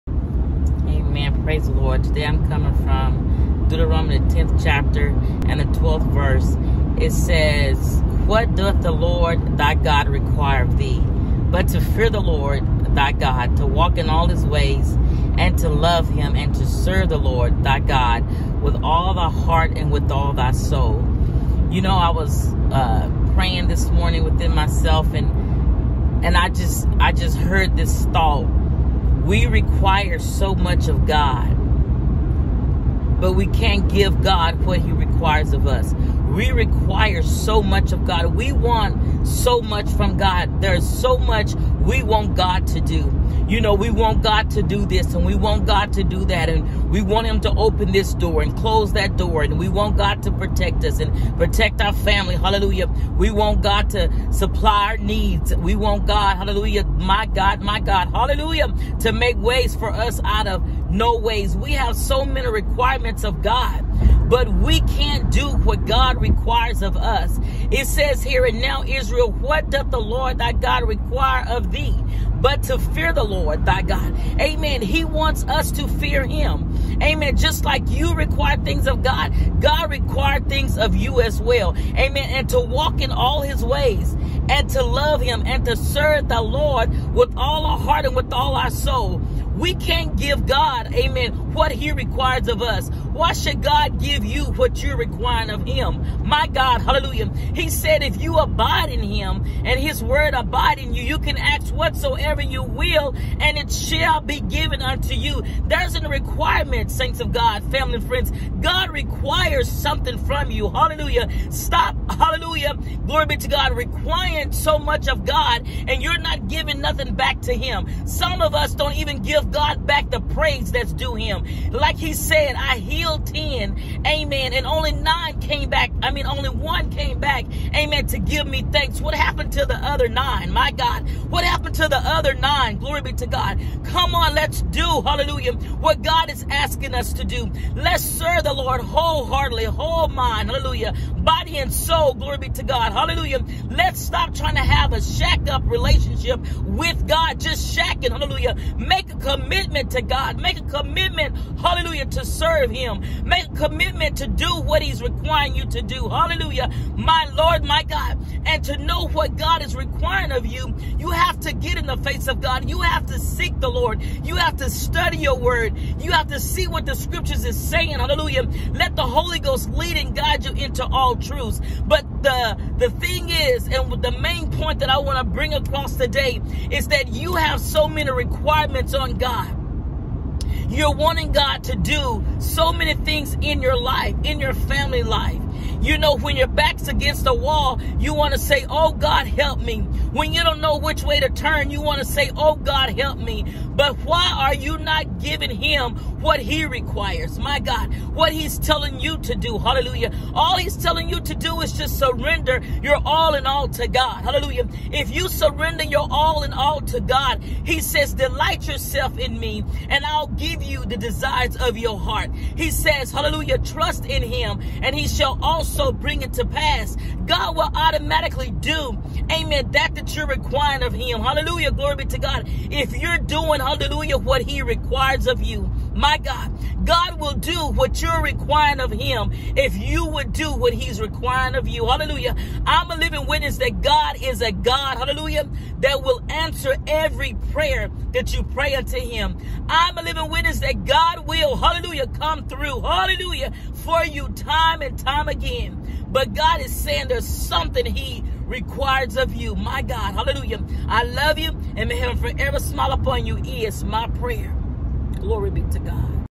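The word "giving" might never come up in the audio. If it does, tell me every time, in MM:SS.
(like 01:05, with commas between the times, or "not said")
01:56, 03:15.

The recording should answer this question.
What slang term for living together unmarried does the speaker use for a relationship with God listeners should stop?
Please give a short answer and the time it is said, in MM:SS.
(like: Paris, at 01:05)
shacked up, at 02:25.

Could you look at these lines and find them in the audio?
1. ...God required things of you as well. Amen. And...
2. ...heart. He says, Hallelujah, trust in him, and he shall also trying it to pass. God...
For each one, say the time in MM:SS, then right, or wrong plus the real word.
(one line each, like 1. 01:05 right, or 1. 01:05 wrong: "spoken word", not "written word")
1. 01:19 right
2. 03:31 wrong: "bring", not "trying".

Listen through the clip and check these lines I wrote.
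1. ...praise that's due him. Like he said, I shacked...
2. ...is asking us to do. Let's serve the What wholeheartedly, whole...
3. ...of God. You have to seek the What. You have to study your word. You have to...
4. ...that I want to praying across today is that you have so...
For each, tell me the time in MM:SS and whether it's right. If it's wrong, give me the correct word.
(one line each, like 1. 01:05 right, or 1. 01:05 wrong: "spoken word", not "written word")
1. 02:00 wrong: "healed", not "shacked"
2. 02:16 wrong: "Lord", not "What"
3. 02:42 wrong: "Lord", not "What"
4. 02:54 wrong: "bring", not "praying".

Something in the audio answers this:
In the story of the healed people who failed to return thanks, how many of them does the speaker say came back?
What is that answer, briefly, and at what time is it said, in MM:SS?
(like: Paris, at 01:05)
1, at 02:06.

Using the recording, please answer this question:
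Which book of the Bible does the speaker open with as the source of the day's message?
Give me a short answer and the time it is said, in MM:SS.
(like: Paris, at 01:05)
Deuteronomy, at 00:03.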